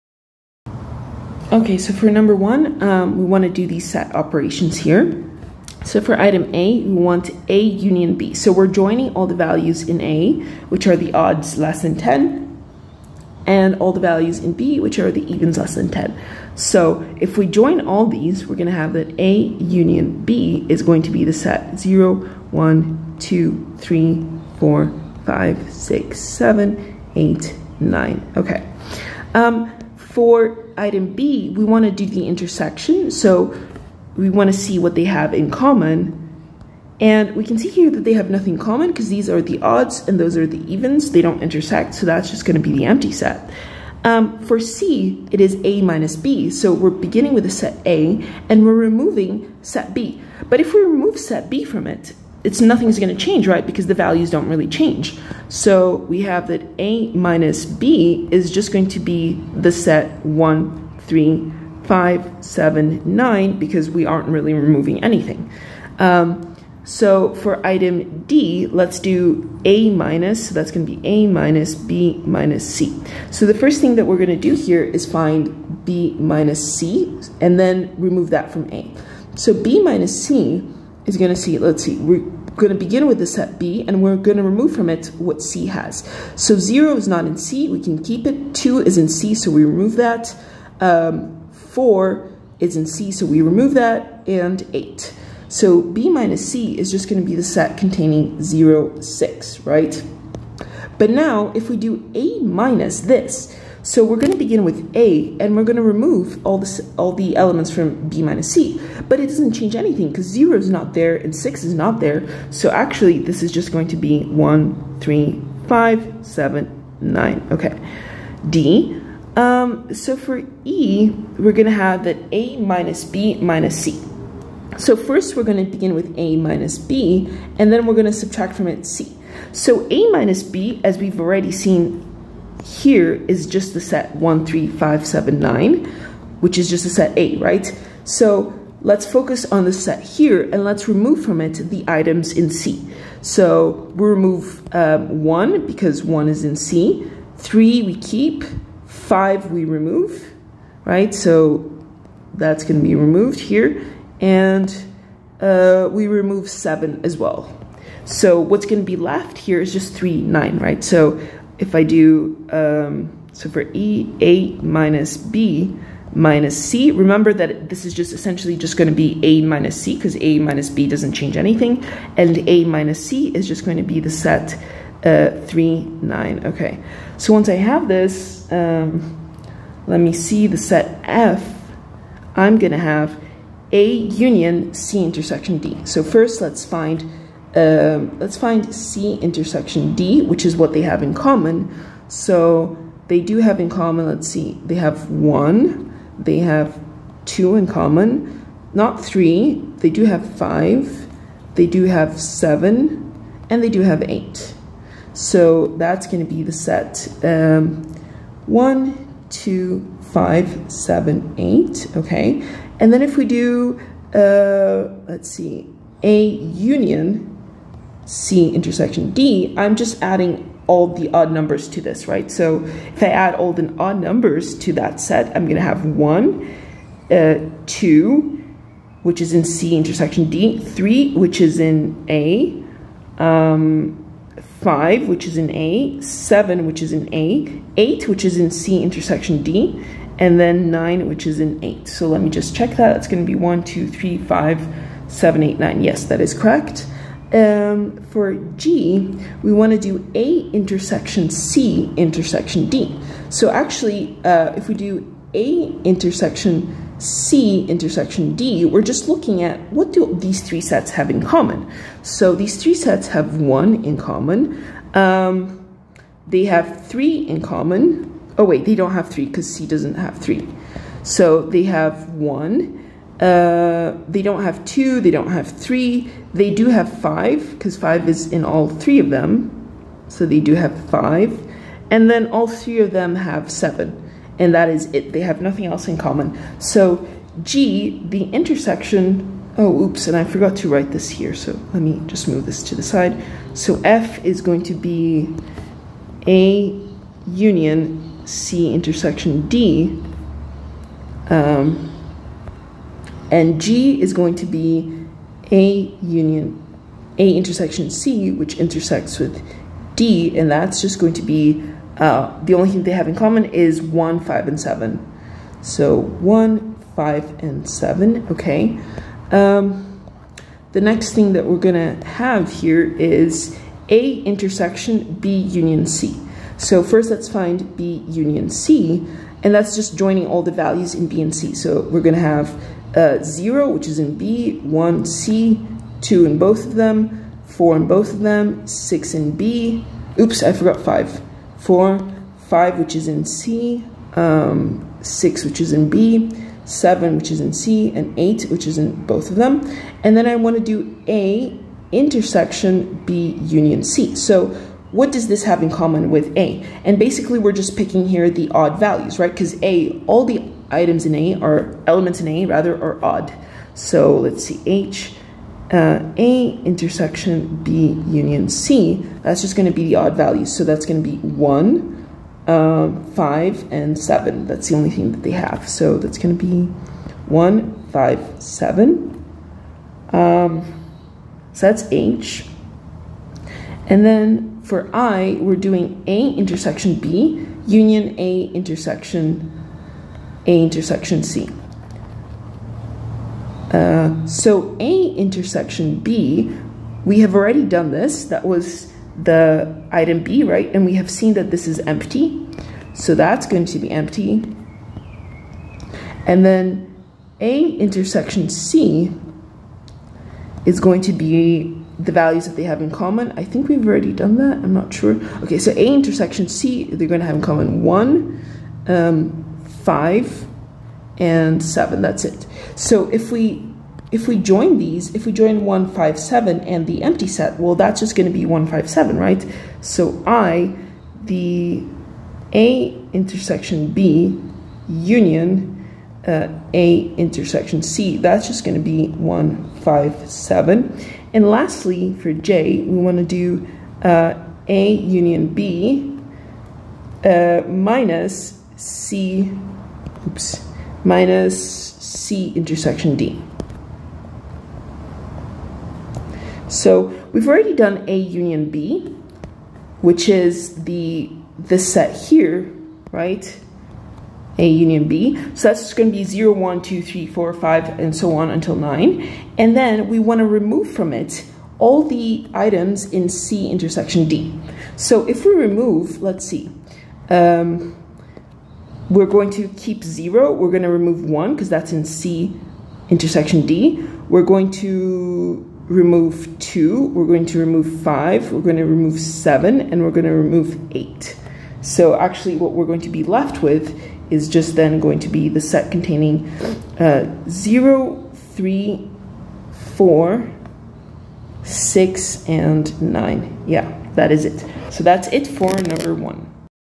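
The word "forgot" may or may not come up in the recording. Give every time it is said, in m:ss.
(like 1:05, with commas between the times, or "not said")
4:50, 5:40.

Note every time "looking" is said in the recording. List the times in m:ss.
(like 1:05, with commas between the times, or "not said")
4:19.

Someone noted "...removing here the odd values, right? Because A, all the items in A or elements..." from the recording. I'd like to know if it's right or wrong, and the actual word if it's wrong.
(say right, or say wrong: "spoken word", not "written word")
wrong: "picking", not "removing".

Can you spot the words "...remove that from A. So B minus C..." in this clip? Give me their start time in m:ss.
1:17.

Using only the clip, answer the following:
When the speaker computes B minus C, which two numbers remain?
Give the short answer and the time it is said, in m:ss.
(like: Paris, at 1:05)
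0, 6, at 1:38.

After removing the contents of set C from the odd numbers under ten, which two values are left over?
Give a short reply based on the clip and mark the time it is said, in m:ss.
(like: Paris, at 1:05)
3, 9, at 2:55.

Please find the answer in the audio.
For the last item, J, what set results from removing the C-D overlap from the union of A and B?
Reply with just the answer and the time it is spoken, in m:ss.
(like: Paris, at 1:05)
0, 3, 4, 6, 9, at 8:17.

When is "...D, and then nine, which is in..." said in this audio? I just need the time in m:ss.
3:59.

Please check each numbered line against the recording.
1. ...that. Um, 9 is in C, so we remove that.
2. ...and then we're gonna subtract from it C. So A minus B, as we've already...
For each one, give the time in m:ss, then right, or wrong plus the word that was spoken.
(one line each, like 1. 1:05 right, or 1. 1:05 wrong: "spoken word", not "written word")
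1. 1:29 wrong: "4", not "9"
2. 2:07 right.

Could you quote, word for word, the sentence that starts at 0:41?
They don't intersect, so that's just going to be the empty set.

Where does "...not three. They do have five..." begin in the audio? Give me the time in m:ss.
3:18.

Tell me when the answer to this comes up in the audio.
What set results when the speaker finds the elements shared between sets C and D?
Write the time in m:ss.
3:28.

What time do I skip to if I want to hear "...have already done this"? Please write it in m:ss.
6:37.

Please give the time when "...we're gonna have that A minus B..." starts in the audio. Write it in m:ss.
2:01.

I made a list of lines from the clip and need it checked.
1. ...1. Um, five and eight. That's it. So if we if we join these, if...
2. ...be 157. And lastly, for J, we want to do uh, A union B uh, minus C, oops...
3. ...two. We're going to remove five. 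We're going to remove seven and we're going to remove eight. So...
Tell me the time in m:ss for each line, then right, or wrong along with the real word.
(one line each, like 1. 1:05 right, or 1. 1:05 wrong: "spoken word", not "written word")
1. 6:57 wrong: "seven", not "eight"
2. 7:18 right
3. 8:06 right.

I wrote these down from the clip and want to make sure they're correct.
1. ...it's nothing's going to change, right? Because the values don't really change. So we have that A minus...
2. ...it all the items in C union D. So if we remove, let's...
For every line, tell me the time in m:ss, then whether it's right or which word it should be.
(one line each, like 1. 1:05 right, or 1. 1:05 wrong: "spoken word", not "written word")
1. 0:52 right
2. 7:51 wrong: "intersection", not "union".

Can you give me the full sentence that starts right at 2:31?
So that's gonna be removed here.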